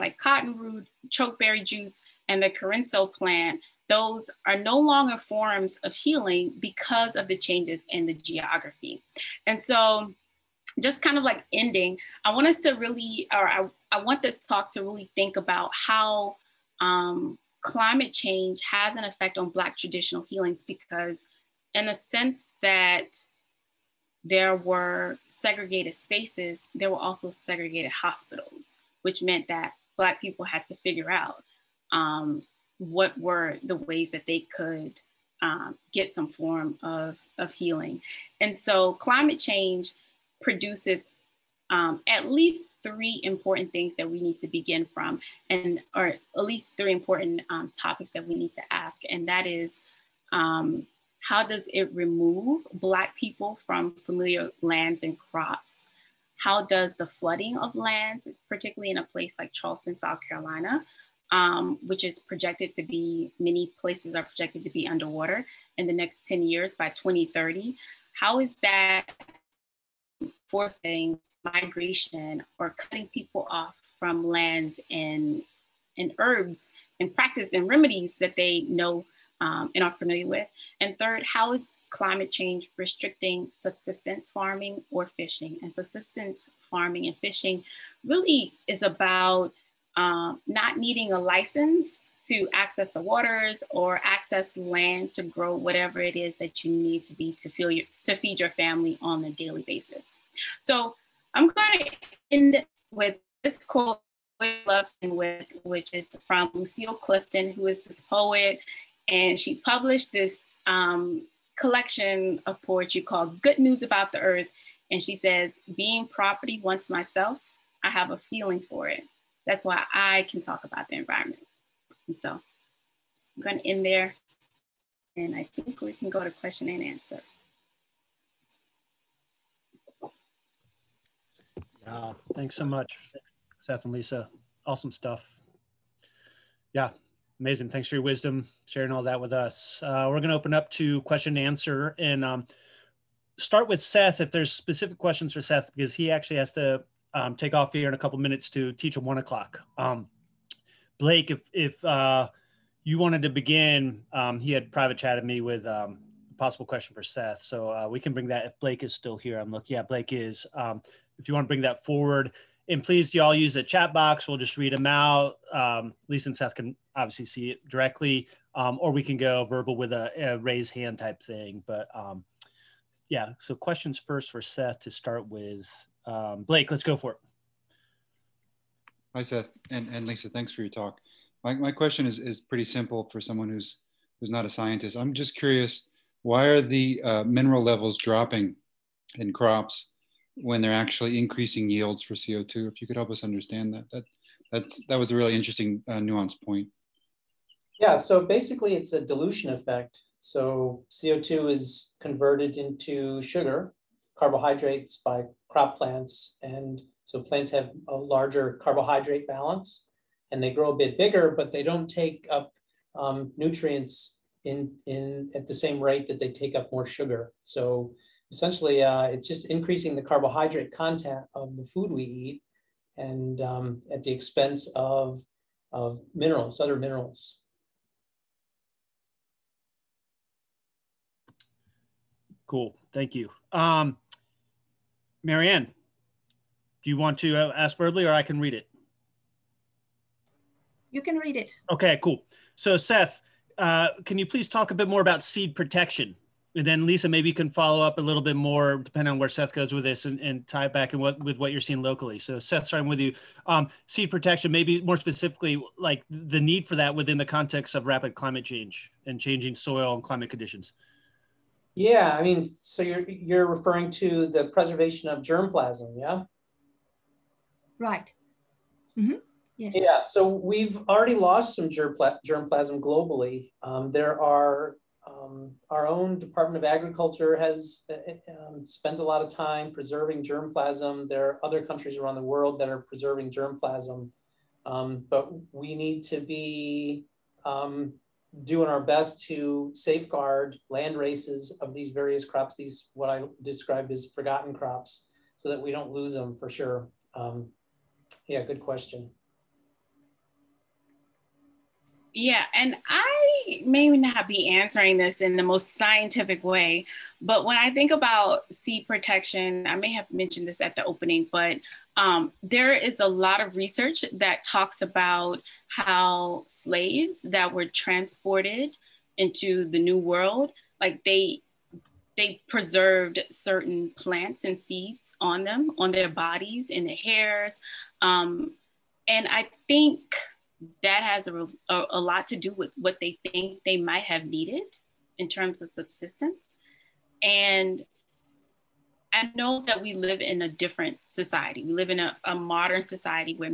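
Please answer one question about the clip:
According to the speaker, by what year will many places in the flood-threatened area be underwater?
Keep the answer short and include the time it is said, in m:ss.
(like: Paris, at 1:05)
2030, at 1:06.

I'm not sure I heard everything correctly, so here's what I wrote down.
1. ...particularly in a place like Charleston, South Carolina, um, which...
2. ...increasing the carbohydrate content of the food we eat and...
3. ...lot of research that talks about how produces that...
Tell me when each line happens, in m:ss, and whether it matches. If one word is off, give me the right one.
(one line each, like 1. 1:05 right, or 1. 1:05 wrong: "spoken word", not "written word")
1. 0:58 right
2. 3:39 right
3. 5:13 wrong: "slaves", not "produces".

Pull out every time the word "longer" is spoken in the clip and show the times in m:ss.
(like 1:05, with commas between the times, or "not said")
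0:04.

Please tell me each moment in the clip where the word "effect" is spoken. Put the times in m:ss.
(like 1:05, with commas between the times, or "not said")
0:19, 3:19.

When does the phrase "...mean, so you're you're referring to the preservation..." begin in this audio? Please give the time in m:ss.
4:22.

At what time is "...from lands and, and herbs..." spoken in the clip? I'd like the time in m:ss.
1:13.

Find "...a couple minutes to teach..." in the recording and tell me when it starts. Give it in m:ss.
2:27.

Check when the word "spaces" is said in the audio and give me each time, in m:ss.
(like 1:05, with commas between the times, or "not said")
0:25.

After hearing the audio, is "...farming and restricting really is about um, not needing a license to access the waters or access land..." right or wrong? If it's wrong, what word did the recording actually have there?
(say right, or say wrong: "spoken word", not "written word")
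wrong: "fishing", not "restricting".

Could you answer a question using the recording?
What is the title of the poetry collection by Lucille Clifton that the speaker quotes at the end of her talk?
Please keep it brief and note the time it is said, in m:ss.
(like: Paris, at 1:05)
Good News About the Earth, at 1:53.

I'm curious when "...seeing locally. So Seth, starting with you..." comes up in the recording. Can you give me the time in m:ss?
4:11.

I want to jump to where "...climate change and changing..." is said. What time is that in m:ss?
4:18.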